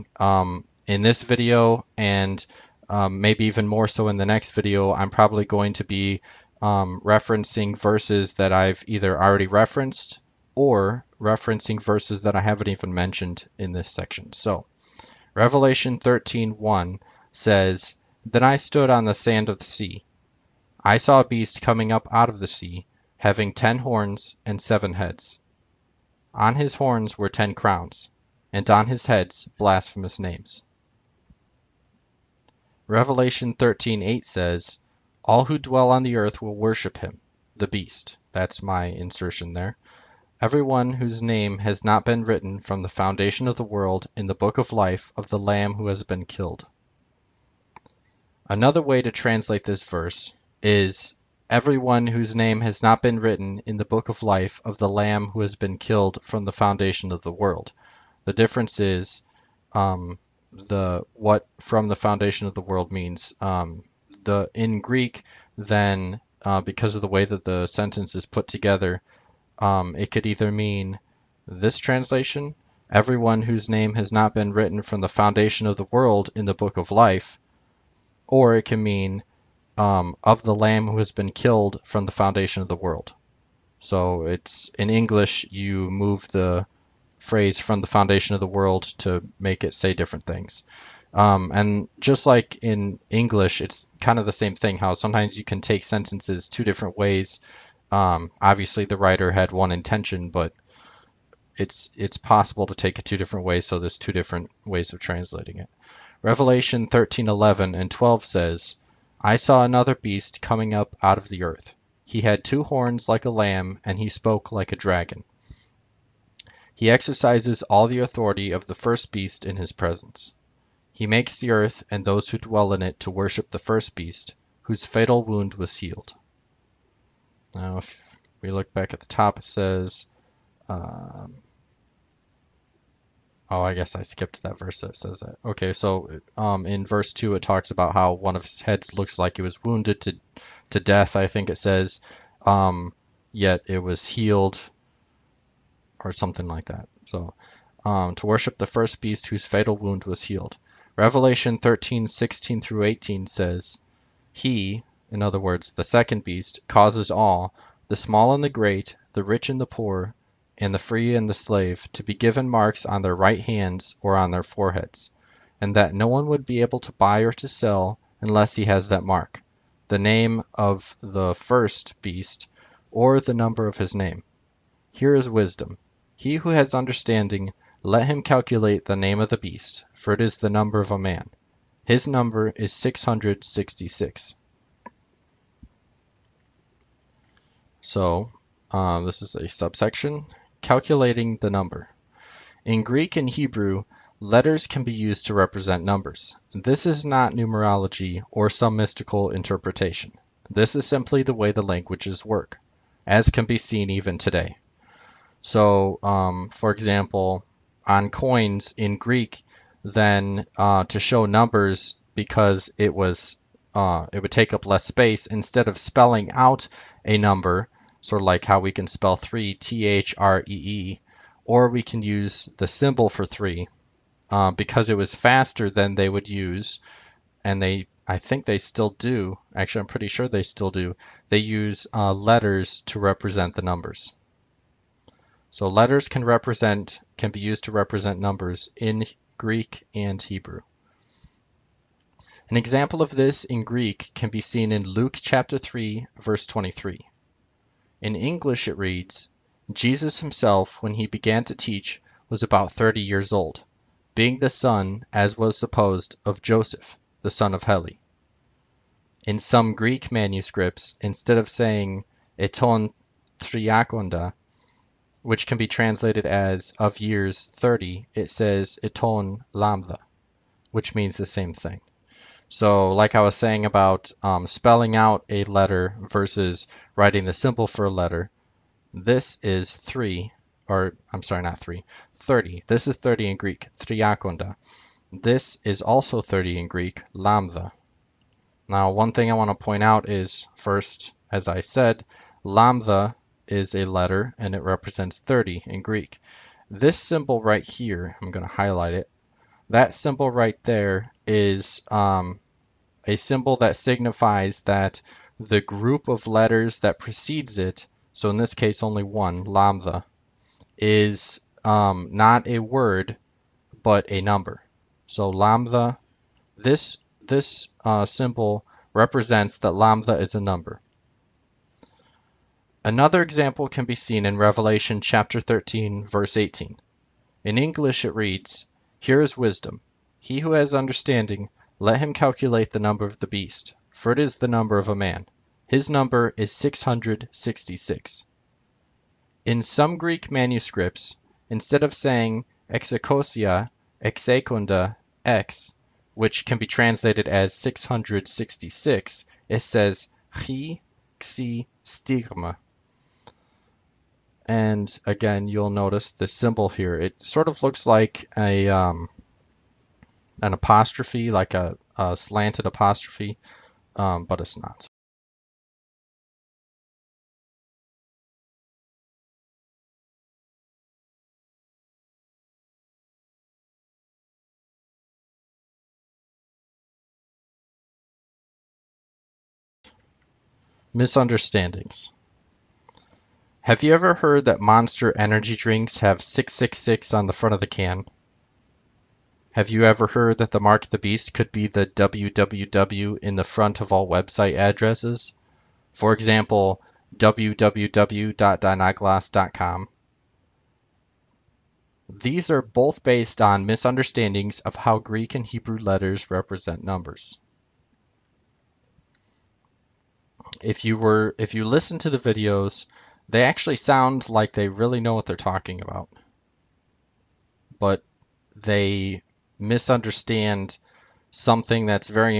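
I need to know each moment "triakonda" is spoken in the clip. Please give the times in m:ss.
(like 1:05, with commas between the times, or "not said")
4:23, 4:43.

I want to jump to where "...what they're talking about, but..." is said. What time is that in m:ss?
6:55.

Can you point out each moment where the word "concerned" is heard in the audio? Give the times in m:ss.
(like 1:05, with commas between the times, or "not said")
not said.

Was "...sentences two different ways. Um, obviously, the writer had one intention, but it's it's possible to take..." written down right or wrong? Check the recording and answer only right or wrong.
right.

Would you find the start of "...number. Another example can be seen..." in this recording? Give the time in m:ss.
5:20.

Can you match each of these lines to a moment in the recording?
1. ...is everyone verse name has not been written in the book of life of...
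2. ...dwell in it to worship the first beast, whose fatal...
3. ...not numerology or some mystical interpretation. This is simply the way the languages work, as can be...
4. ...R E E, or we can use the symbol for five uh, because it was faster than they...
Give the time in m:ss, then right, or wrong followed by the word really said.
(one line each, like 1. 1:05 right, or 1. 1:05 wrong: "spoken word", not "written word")
1. 0:50 wrong: "whose", not "verse"
2. 2:02 right
3. 3:17 right
4. 3:40 wrong: "three", not "five".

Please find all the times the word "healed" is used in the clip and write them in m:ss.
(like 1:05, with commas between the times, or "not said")
2:05, 2:24, 2:30.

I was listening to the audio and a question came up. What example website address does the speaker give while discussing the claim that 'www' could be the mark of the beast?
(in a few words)
www.dinagloss.com.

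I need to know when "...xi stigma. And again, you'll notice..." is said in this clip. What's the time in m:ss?
5:51.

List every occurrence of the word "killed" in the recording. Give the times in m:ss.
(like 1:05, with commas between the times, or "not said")
0:46, 0:55, 1:21.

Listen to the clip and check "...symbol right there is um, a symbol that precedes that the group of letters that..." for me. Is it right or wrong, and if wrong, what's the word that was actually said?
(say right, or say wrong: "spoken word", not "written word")
wrong: "signifies", not "precedes".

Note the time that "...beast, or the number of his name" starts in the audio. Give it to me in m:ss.
2:52.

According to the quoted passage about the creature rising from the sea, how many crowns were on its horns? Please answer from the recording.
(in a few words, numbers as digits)
10.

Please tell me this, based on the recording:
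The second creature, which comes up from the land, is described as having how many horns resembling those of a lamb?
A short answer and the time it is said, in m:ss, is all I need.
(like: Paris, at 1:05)
2, at 1:52.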